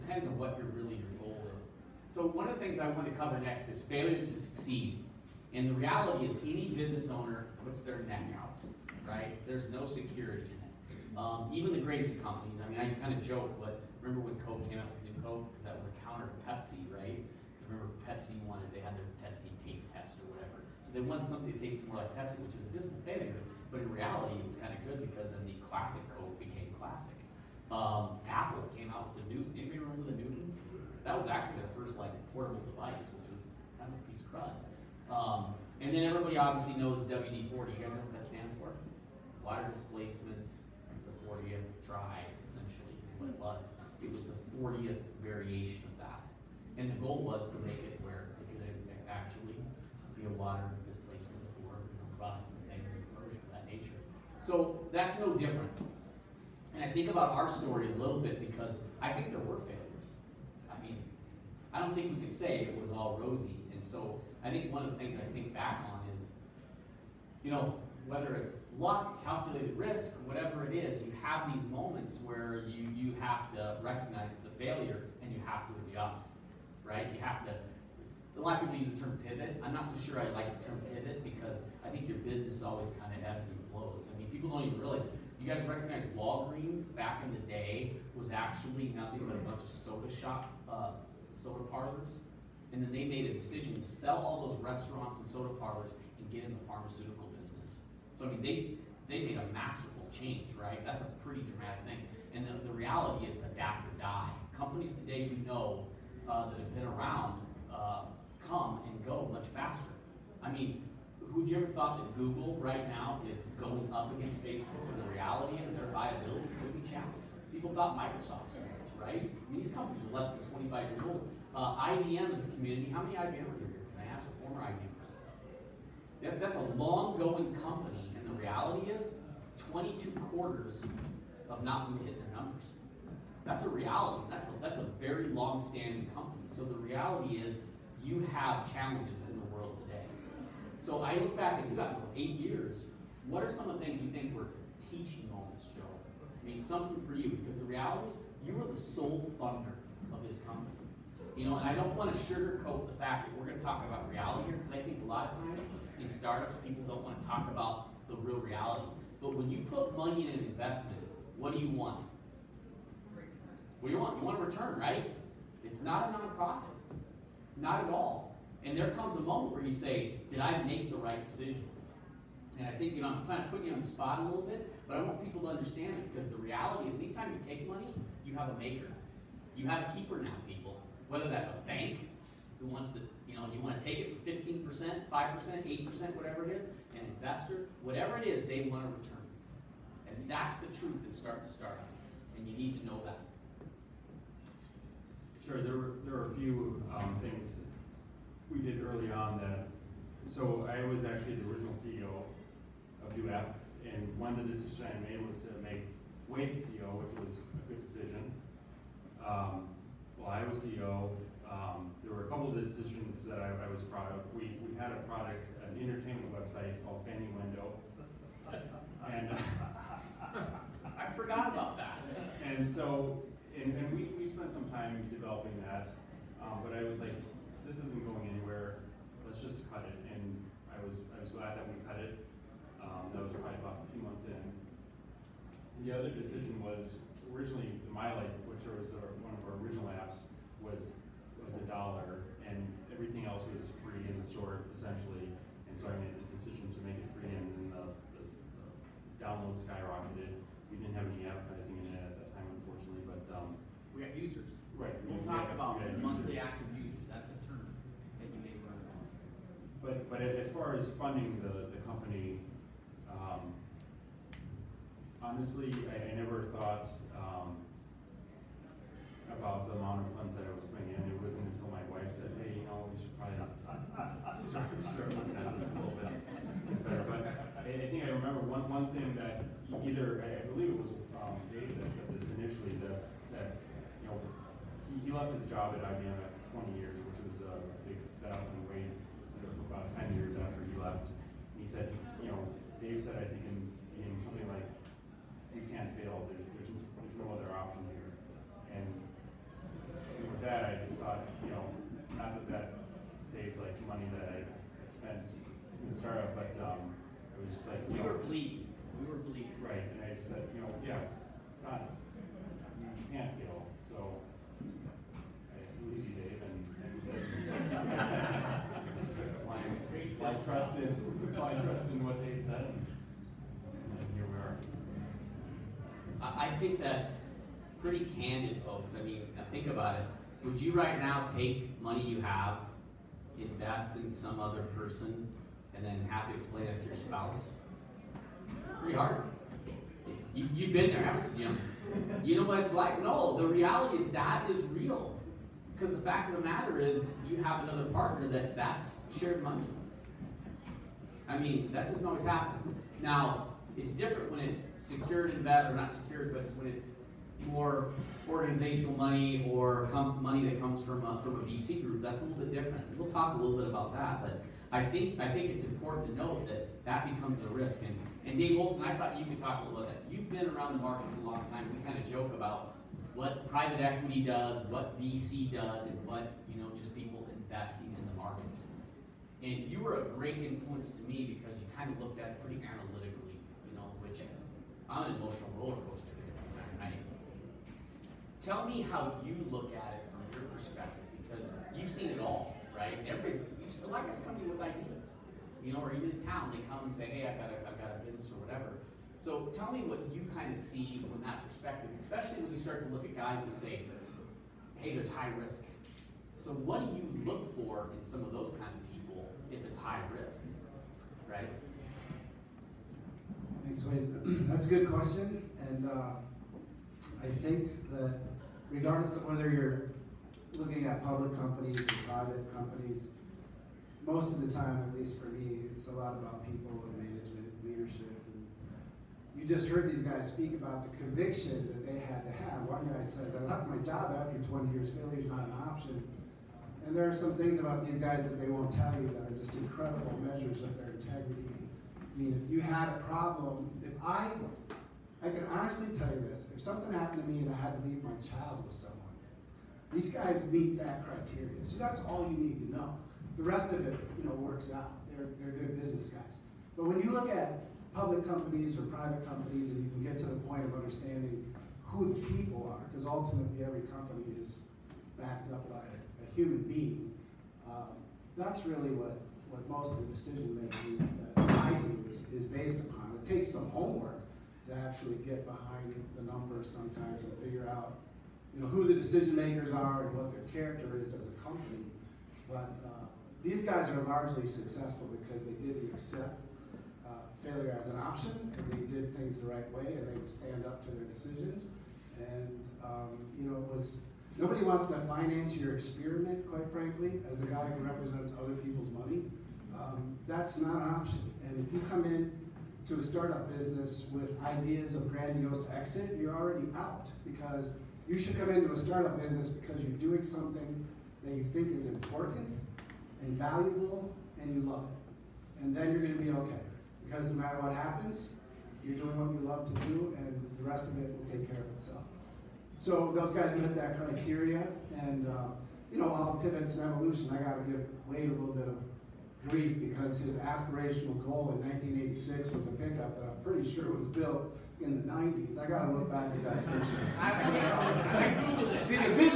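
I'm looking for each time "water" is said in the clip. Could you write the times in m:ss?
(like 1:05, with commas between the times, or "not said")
0:39, 0:50.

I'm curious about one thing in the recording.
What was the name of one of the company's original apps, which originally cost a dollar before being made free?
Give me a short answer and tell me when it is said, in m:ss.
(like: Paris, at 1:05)
MyLife, at 3:57.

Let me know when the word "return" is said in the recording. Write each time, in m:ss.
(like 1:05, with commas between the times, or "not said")
2:44, 3:08.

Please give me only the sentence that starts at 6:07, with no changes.
And, and Dave Olson, I thought you could talk a little bit.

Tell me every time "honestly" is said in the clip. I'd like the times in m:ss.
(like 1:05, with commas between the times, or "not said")
4:25, 7:25.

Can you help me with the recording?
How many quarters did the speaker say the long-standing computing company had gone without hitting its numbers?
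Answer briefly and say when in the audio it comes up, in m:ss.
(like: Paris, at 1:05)
22, at 2:09.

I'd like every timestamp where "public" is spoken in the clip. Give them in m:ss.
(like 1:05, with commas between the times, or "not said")
7:01, 7:37.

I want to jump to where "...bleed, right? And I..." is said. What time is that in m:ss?
5:09.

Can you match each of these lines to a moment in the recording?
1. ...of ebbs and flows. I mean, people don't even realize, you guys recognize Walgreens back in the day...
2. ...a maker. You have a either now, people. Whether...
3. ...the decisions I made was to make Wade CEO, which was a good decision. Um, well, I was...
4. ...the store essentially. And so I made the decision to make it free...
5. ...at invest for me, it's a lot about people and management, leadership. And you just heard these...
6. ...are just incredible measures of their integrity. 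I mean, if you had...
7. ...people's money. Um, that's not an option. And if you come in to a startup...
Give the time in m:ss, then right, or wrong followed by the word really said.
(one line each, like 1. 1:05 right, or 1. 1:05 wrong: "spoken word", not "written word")
1. 1:23 right
2. 2:58 wrong: "keeper", not "either"
3. 3:24 right
4. 4:04 right
5. 7:04 wrong: "least", not "invest"
6. 7:19 right
7. 8:18 right.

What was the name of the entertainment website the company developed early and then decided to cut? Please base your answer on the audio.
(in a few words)
Fanuendo.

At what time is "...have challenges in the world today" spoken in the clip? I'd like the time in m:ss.
2:18.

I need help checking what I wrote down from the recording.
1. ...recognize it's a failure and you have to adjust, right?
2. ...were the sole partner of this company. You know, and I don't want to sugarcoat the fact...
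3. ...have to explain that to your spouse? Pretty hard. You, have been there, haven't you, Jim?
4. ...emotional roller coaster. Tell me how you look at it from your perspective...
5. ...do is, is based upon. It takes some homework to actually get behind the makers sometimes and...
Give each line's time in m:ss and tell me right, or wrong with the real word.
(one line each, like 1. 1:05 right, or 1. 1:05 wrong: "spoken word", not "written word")
1. 1:13 right
2. 2:28 wrong: "funder", not "partner"
3. 5:36 right
4. 6:25 right
5. 7:51 wrong: "numbers", not "makers".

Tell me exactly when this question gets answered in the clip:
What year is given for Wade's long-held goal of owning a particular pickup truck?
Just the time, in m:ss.
8:51.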